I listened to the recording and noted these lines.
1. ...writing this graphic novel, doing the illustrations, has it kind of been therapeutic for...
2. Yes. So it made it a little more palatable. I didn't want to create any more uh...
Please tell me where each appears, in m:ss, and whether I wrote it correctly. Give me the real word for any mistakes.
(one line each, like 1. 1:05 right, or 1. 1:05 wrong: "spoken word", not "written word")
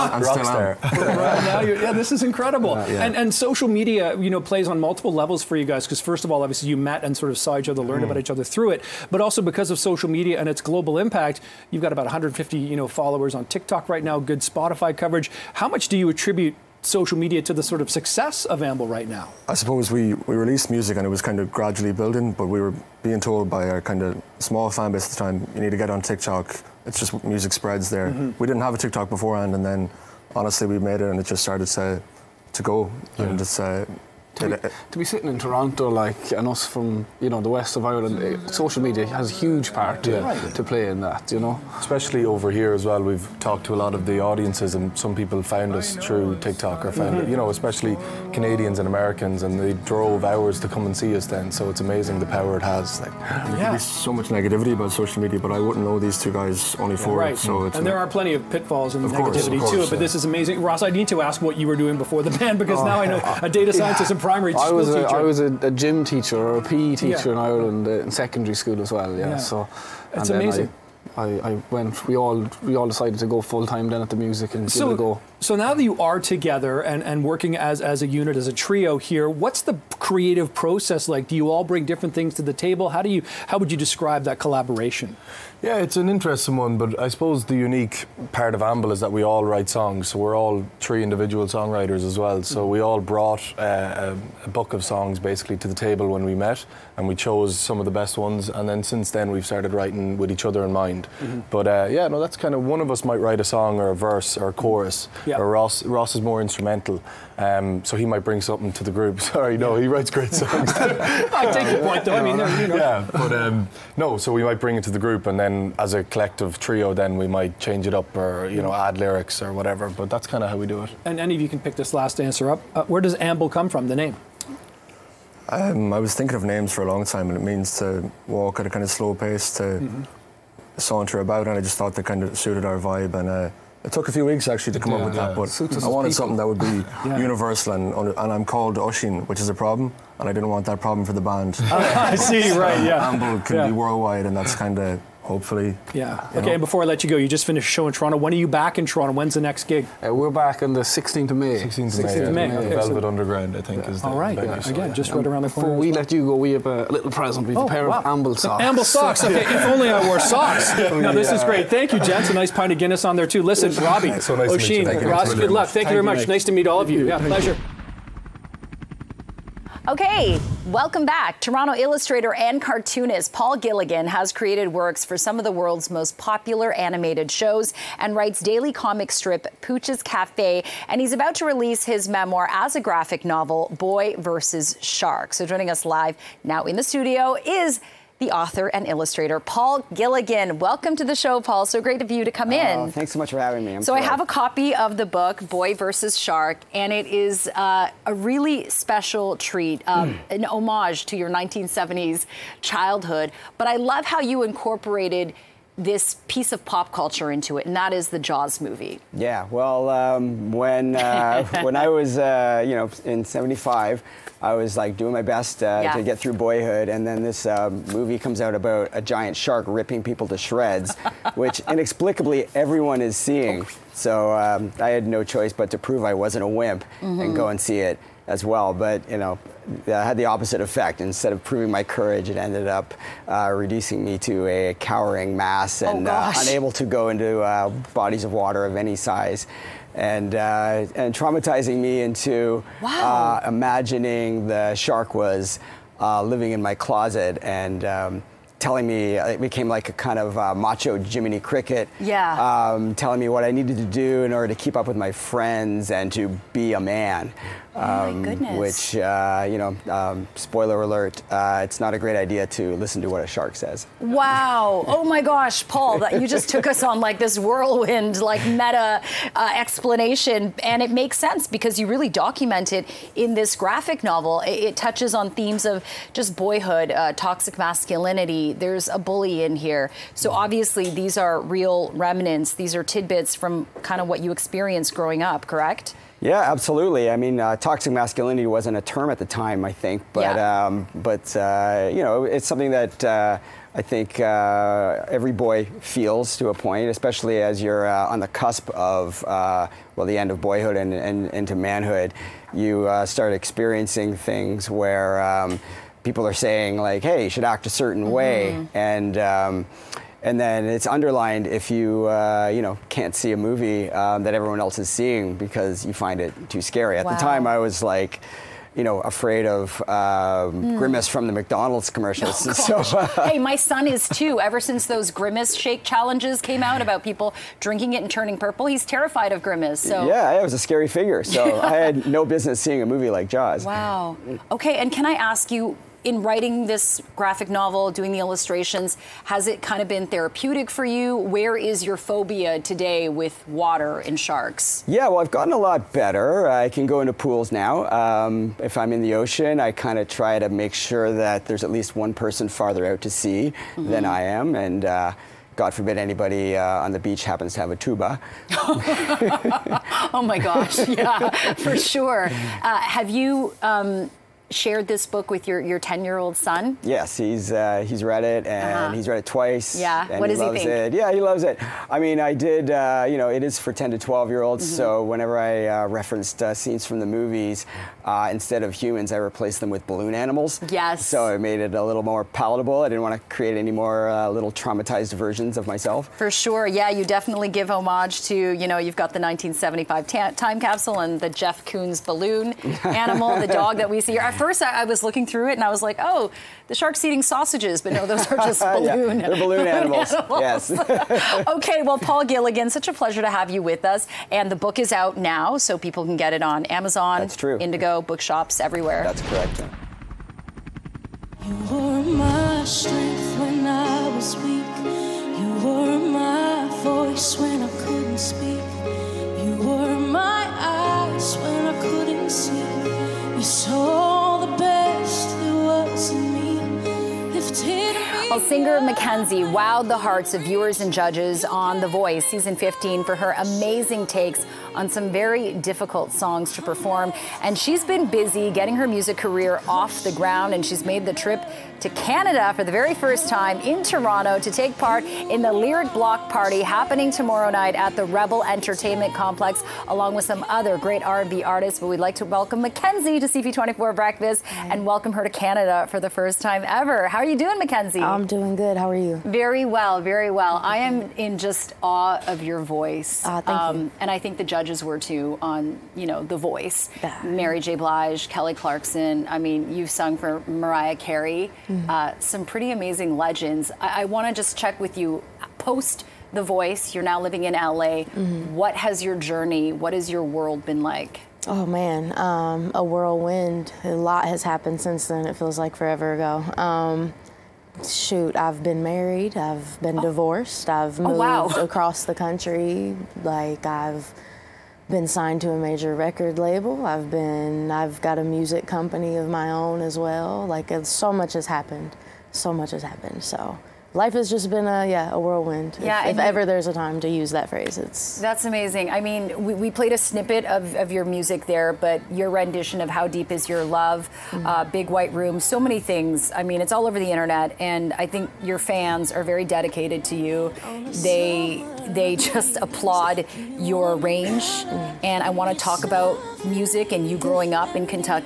1. 5:36 right
2. 6:20 right.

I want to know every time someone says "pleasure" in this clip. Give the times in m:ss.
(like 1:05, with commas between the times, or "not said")
2:47, 6:42.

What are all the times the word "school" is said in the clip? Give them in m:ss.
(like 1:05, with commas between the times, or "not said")
1:04, 1:08.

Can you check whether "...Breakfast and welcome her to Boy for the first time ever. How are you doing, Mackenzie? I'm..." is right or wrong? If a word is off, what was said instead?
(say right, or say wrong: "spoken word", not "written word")
wrong: "Canada", not "Boy".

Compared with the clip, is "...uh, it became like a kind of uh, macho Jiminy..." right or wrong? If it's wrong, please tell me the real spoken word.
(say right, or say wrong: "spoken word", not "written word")
right.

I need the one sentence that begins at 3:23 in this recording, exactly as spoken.
But I love how you incorporated this piece of pop culture into it, and that is the Jaws movie.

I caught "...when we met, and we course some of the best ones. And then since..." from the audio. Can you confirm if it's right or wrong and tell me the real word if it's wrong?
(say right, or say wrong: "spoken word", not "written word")
wrong: "chose", not "course".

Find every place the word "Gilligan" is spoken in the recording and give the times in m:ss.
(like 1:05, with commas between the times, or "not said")
2:53, 3:09, 6:42.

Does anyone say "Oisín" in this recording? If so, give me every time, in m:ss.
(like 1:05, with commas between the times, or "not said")
2:18, 2:44.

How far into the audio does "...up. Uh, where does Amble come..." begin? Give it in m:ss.
2:02.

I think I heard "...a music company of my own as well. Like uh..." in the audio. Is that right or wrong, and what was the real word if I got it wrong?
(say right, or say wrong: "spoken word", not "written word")
right.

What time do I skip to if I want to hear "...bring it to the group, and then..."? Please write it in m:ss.
1:54.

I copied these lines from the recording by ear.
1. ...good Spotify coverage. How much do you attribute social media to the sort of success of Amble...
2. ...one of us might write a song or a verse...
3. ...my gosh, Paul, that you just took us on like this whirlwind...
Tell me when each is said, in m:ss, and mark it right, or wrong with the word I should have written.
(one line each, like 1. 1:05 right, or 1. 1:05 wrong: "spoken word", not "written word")
1. 0:14 right
2. 1:42 right
3. 4:25 right.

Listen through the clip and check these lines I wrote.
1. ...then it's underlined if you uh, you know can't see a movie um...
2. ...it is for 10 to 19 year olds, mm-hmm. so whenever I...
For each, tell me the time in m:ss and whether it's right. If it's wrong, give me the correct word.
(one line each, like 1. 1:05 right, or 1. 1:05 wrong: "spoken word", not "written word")
1. 5:10 right
2. 6:13 wrong: "12", not "19".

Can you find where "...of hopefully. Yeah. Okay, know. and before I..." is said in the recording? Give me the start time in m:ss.
2:24.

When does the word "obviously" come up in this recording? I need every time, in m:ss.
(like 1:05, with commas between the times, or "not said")
0:06, 4:40.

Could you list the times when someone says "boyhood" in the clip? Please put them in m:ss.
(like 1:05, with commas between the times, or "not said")
3:36, 4:36, 5:00.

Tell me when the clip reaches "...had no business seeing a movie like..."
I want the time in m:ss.
5:31.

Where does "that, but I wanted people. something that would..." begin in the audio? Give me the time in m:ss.
2:15.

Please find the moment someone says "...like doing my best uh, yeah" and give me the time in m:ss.
3:34.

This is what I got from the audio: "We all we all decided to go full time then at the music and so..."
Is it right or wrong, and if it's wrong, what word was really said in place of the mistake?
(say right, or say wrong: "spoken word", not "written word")
right.